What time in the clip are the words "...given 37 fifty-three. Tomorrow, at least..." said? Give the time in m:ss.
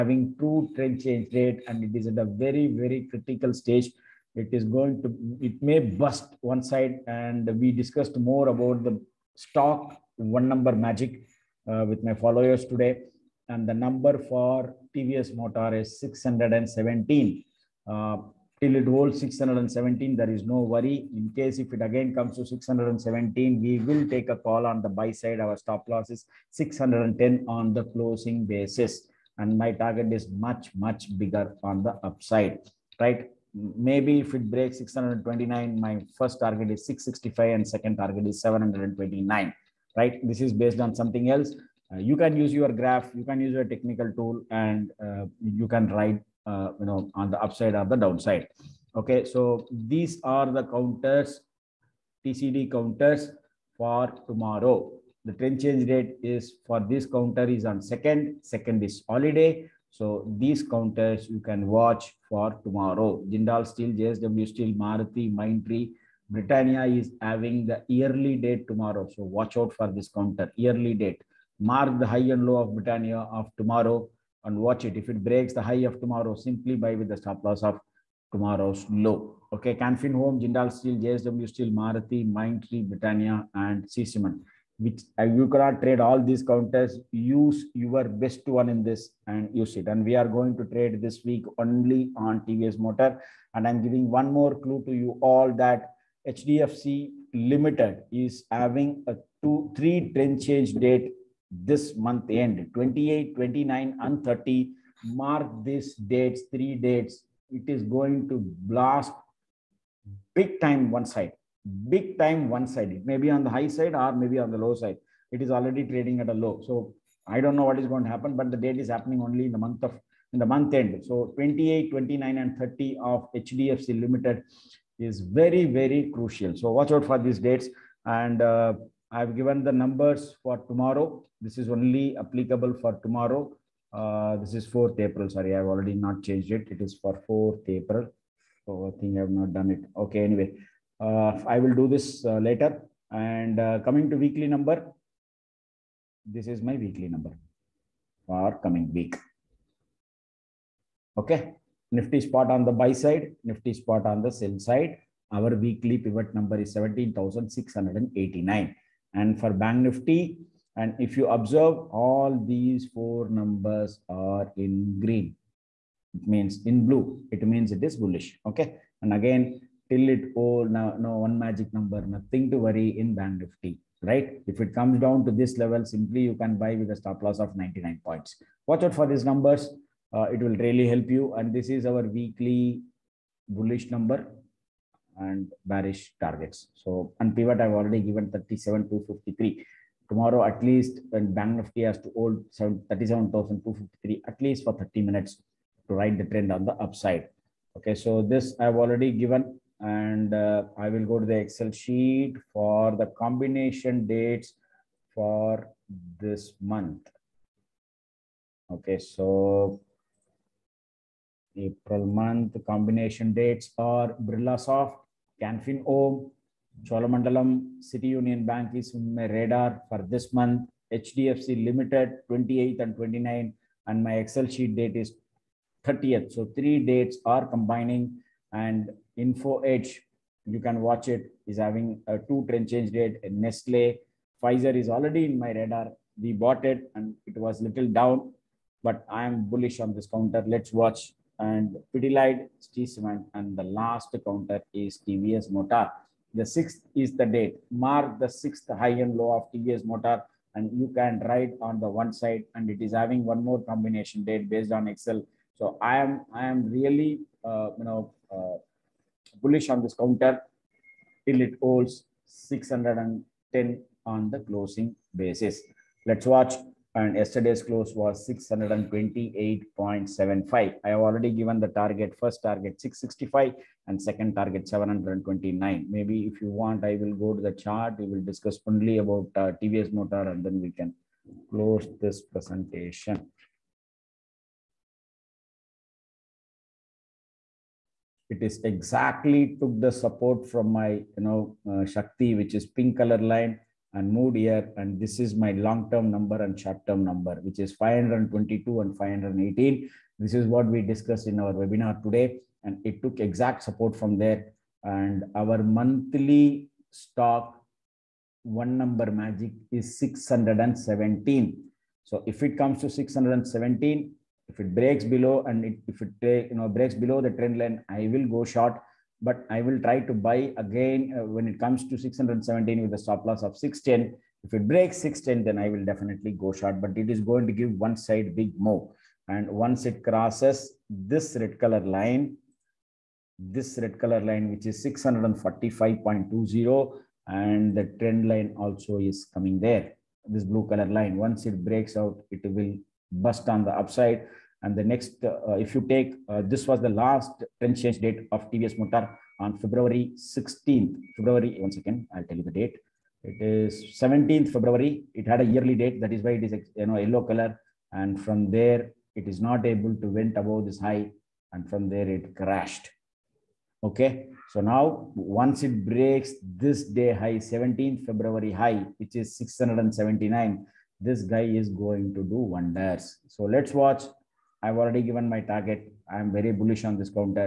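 3:07.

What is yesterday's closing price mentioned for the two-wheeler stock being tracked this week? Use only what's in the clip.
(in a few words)
628.75.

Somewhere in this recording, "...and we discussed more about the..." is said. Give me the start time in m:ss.
0:07.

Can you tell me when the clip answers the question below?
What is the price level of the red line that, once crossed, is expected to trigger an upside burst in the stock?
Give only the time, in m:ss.
5:34.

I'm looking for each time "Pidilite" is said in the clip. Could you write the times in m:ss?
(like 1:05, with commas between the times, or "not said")
4:01.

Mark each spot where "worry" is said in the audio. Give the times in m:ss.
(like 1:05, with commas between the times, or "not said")
0:20, 2:52.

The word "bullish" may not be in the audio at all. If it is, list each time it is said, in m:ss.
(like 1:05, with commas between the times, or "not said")
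2:47, 3:03, 3:59, 4:19, 6:16.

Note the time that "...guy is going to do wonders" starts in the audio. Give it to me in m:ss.
6:11.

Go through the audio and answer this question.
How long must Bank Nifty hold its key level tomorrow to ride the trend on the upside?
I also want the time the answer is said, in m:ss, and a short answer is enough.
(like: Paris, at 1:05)
30 minutes, at 3:14.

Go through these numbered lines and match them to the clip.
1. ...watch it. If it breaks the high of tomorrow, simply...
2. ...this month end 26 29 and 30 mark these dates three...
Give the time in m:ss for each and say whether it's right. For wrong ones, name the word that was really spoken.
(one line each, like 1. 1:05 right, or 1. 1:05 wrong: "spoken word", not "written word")
1. 1:14 right
2. 1:41 wrong: "28", not "26".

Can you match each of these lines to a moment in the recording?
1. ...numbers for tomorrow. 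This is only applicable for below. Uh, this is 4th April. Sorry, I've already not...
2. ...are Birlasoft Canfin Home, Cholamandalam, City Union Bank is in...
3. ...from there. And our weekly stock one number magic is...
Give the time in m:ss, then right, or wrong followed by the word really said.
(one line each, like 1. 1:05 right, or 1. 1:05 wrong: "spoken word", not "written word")
1. 2:09 wrong: "tomorrow", not "below"
2. 3:33 right
3. 5:03 wrong: "monthly", not "weekly".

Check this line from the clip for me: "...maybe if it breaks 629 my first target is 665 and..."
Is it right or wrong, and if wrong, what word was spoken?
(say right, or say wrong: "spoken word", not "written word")
right.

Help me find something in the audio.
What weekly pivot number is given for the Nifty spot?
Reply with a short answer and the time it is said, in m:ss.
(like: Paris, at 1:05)
17,689, at 2:36.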